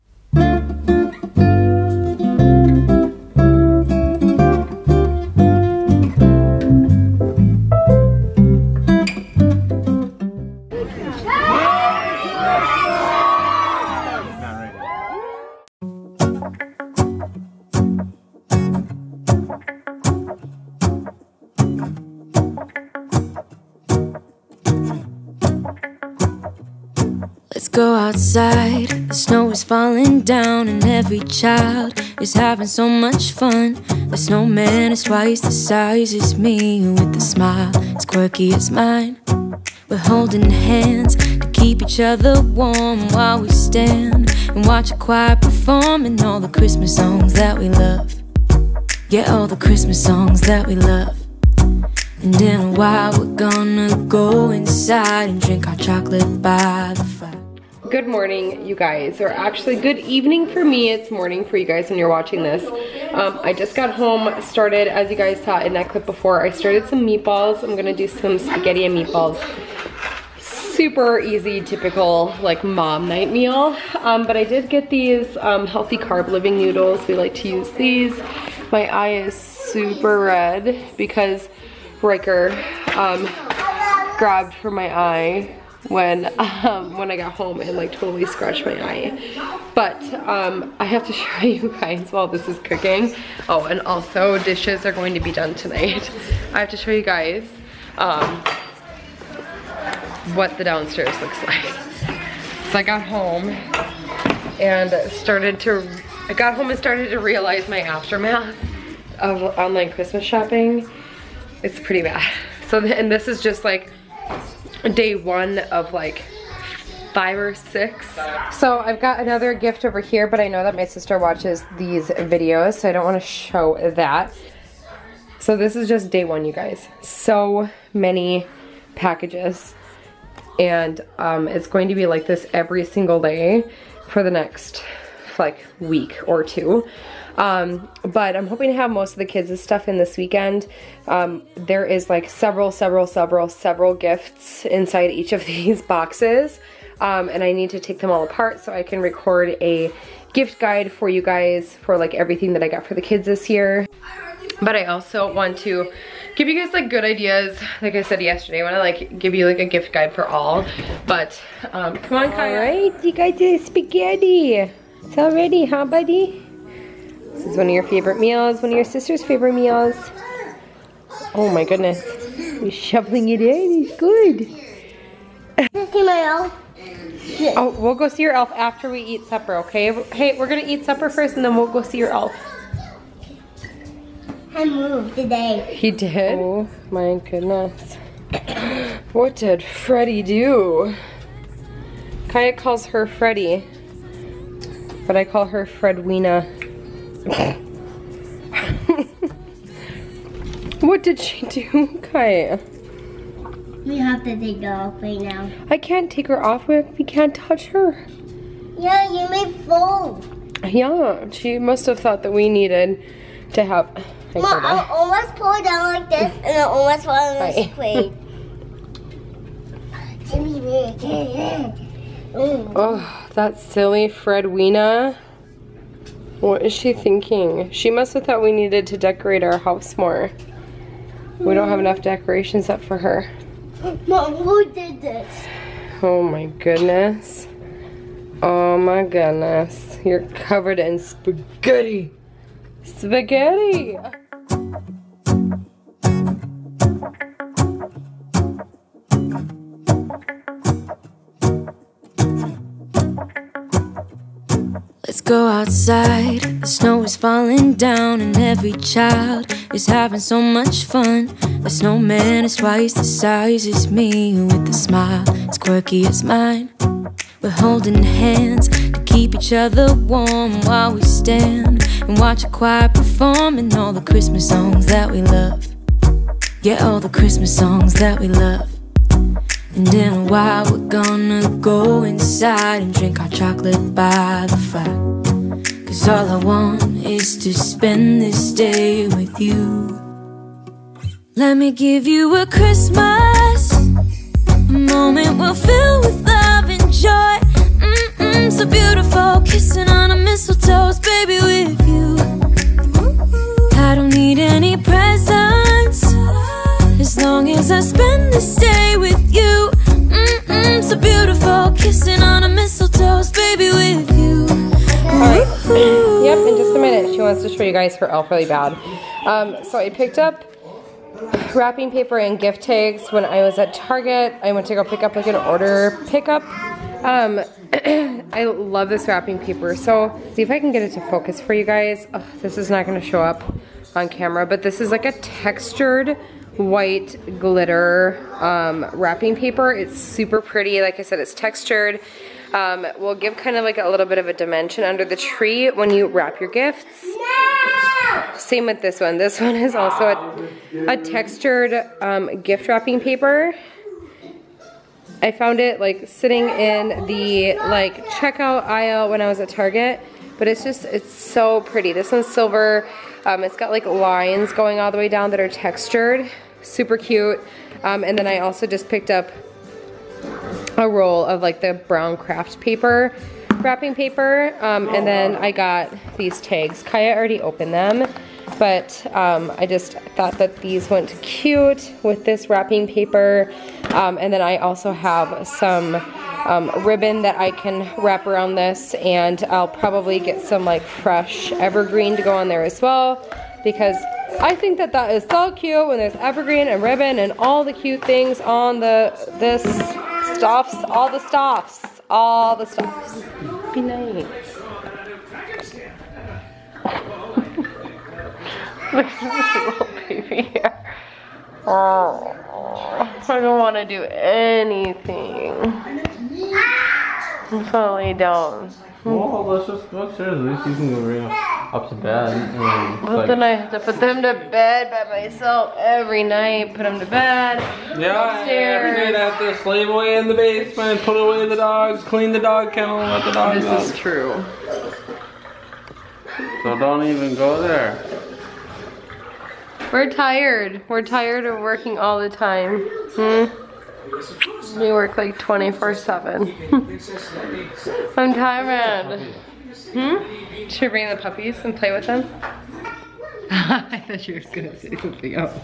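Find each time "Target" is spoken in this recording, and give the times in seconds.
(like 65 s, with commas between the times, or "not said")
323 s, 359 s.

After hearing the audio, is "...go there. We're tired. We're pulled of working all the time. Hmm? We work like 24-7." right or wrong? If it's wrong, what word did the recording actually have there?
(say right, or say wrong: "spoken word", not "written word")
wrong: "tired", not "pulled".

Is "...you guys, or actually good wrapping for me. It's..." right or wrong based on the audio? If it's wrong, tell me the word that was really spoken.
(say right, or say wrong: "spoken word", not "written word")
wrong: "evening", not "wrapping".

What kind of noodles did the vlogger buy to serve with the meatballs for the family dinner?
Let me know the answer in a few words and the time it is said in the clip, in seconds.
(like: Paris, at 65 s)
healthy carb living noodles, at 75 s.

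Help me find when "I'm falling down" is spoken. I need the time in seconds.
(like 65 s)
417 s.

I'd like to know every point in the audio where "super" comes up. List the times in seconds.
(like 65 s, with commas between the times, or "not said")
70 s, 79 s, 339 s, 366 s.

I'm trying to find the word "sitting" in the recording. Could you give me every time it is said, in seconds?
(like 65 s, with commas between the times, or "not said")
356 s.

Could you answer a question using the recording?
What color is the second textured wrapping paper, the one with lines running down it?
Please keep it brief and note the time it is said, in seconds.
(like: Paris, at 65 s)
Silver, at 362 s.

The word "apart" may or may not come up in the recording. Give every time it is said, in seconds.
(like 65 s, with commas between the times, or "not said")
148 s.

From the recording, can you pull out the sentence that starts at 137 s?
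Um, but I'm hoping to have most of the kids' stuff in this weekend.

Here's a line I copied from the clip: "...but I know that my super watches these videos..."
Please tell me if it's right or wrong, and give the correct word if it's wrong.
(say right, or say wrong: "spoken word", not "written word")
wrong: "sister", not "super".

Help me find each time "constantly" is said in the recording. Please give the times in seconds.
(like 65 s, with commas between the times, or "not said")
not said.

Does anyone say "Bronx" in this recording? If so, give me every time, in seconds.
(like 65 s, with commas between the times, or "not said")
not said.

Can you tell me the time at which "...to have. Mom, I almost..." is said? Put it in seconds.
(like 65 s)
213 s.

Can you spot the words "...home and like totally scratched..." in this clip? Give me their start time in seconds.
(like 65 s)
87 s.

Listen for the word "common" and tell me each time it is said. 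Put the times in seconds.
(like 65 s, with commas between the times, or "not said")
not said.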